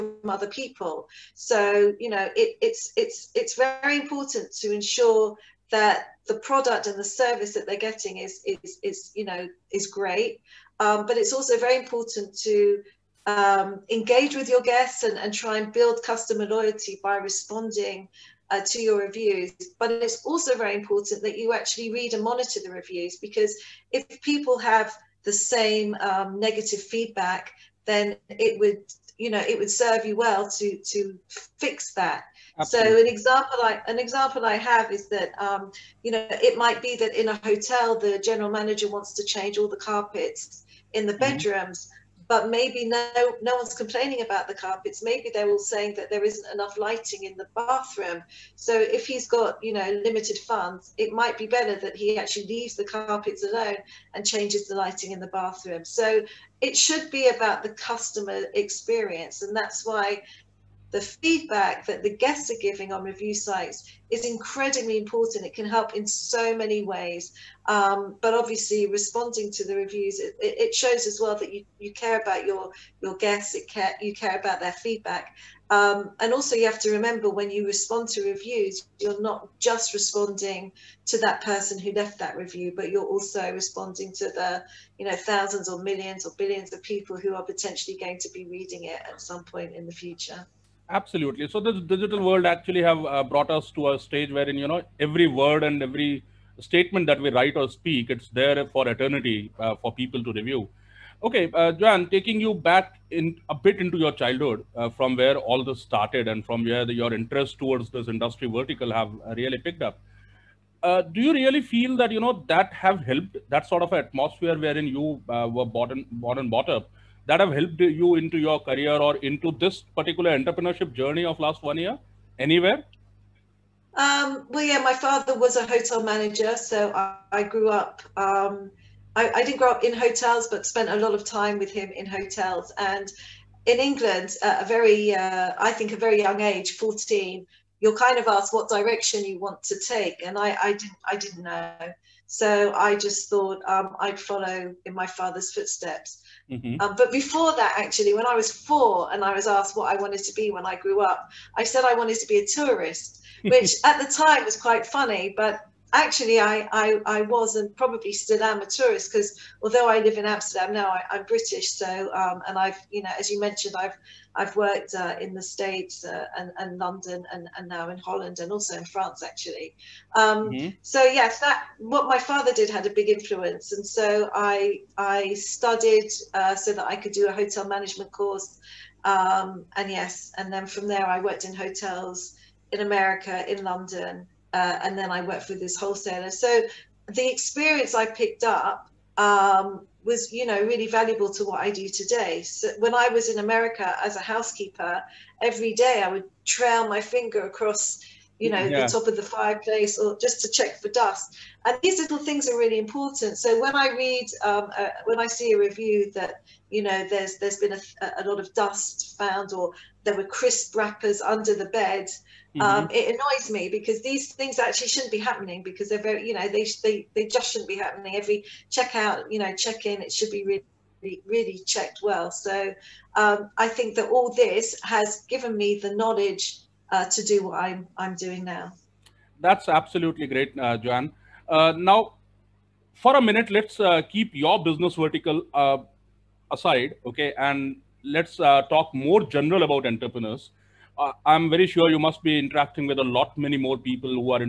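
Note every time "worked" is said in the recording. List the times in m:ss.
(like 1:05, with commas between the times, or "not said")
2:44, 3:01, 3:05.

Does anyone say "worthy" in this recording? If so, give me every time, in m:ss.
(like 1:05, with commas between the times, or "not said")
not said.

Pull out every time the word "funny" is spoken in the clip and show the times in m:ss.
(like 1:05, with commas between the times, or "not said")
2:34.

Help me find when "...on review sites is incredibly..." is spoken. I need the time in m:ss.
1:02.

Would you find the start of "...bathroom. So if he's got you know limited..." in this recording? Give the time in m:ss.
0:47.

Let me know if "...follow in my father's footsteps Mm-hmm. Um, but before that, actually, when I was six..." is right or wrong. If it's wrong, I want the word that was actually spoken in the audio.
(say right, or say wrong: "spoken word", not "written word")
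wrong: "four", not "six".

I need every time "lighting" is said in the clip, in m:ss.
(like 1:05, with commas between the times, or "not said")
0:46, 0:54.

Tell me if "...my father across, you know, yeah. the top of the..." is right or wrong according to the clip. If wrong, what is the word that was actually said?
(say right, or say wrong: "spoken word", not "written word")
wrong: "finger", not "father".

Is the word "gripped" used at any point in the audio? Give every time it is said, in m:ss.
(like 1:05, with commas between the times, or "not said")
not said.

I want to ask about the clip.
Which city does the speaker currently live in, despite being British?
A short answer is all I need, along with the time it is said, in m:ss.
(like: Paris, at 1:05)
Amsterdam, at 2:40.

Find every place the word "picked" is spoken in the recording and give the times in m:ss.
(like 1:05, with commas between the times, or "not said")
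1:49, 3:08.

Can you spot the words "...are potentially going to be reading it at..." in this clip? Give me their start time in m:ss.
1:27.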